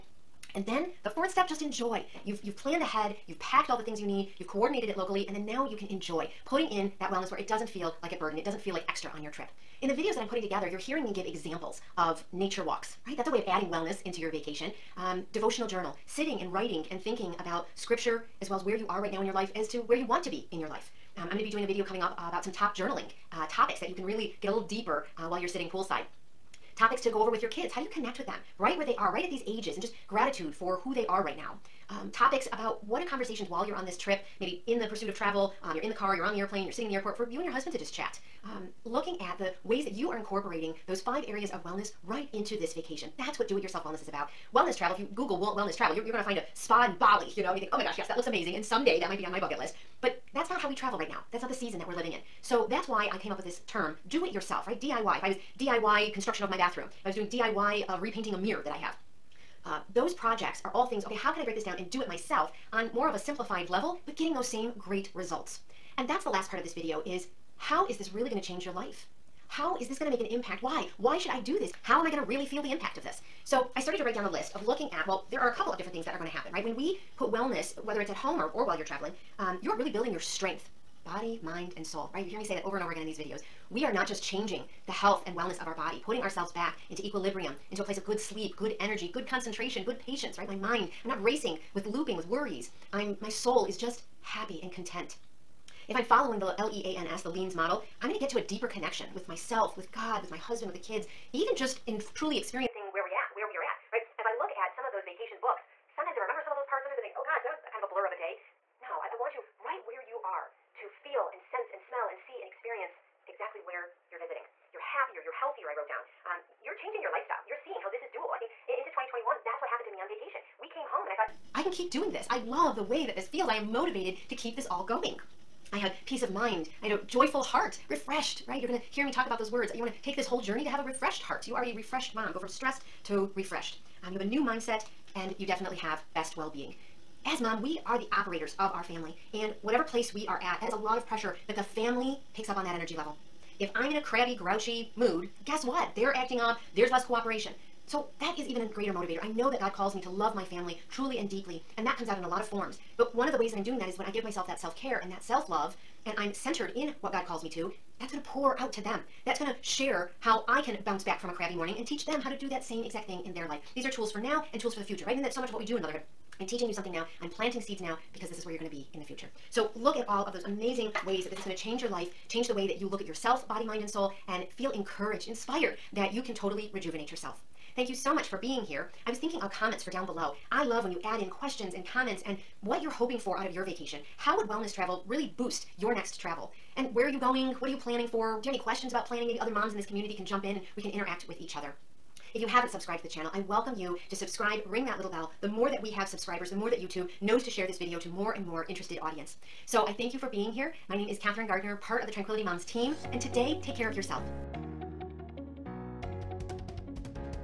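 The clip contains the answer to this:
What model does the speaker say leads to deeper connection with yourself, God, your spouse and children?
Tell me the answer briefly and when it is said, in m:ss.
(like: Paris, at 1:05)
LEANS model, at 1:37.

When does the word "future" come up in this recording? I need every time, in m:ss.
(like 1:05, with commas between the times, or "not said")
2:44, 2:49.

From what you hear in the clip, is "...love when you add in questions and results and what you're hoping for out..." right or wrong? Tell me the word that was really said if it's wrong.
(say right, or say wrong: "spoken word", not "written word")
wrong: "comments", not "results".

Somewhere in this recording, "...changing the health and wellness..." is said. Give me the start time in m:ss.
1:24.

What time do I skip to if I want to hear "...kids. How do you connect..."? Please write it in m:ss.
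0:27.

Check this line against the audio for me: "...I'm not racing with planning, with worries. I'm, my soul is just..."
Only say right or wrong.
wrong.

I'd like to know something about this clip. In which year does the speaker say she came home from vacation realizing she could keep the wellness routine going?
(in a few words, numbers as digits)
2021.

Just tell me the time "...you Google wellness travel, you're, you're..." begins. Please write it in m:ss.
0:44.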